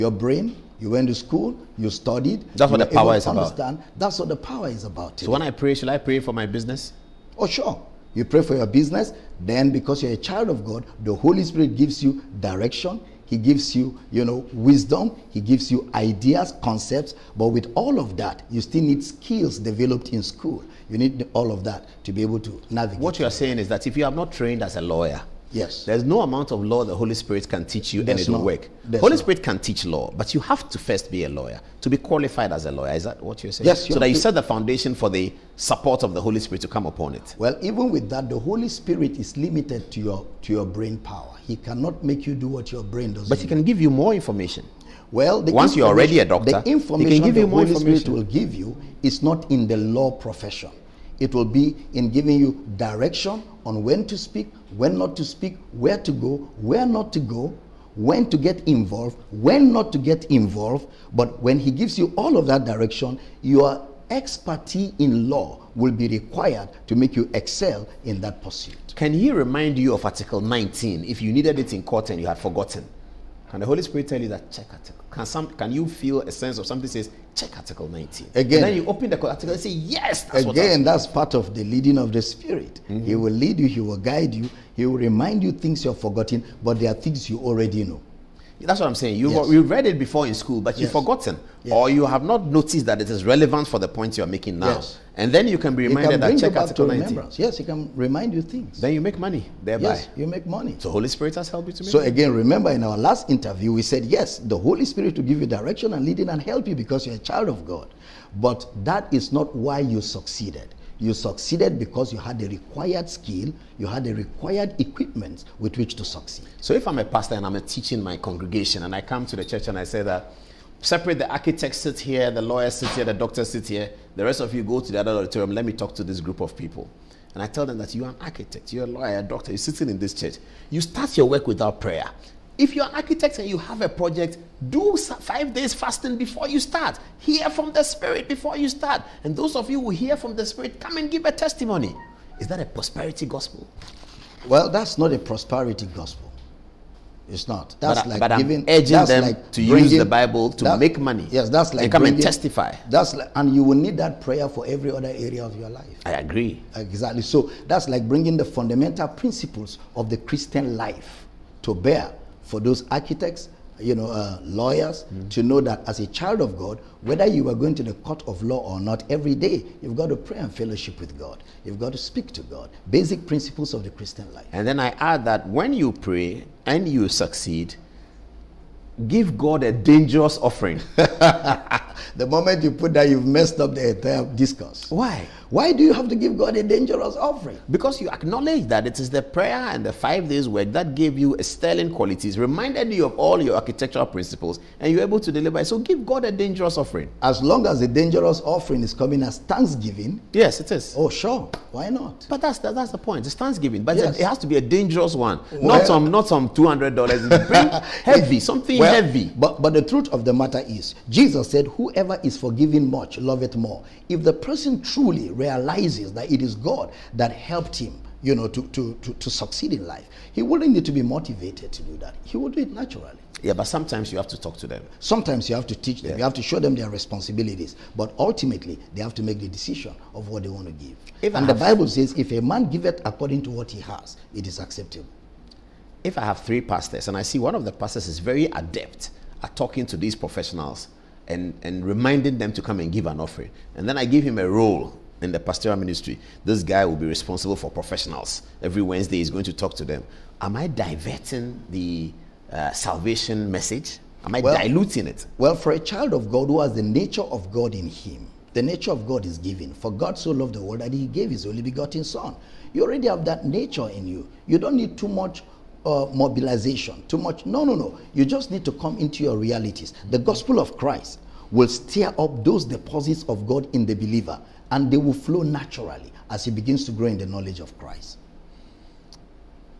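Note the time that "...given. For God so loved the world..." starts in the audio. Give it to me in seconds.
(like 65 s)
259 s.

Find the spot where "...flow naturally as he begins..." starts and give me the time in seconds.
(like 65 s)
275 s.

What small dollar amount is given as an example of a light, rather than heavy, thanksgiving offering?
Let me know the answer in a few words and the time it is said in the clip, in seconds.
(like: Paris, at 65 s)
$200, at 206 s.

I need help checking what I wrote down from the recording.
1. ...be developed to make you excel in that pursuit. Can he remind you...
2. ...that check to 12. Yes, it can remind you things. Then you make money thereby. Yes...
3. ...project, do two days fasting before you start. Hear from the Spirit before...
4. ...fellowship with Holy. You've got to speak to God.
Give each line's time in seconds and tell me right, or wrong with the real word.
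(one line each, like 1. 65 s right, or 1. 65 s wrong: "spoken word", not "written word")
1. 65 s wrong: "required", not "developed"
2. 96 s wrong: "19", not "12"
3. 133 s wrong: "five", not "two"
4. 170 s wrong: "God", not "Holy".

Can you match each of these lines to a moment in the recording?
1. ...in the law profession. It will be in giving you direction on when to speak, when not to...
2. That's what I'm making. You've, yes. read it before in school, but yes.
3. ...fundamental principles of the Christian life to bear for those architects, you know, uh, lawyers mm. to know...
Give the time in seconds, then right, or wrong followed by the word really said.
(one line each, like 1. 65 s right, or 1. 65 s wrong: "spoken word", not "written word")
1. 49 s right
2. 88 s wrong: "saying", not "making"
3. 158 s right.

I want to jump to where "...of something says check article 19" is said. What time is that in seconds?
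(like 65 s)
76 s.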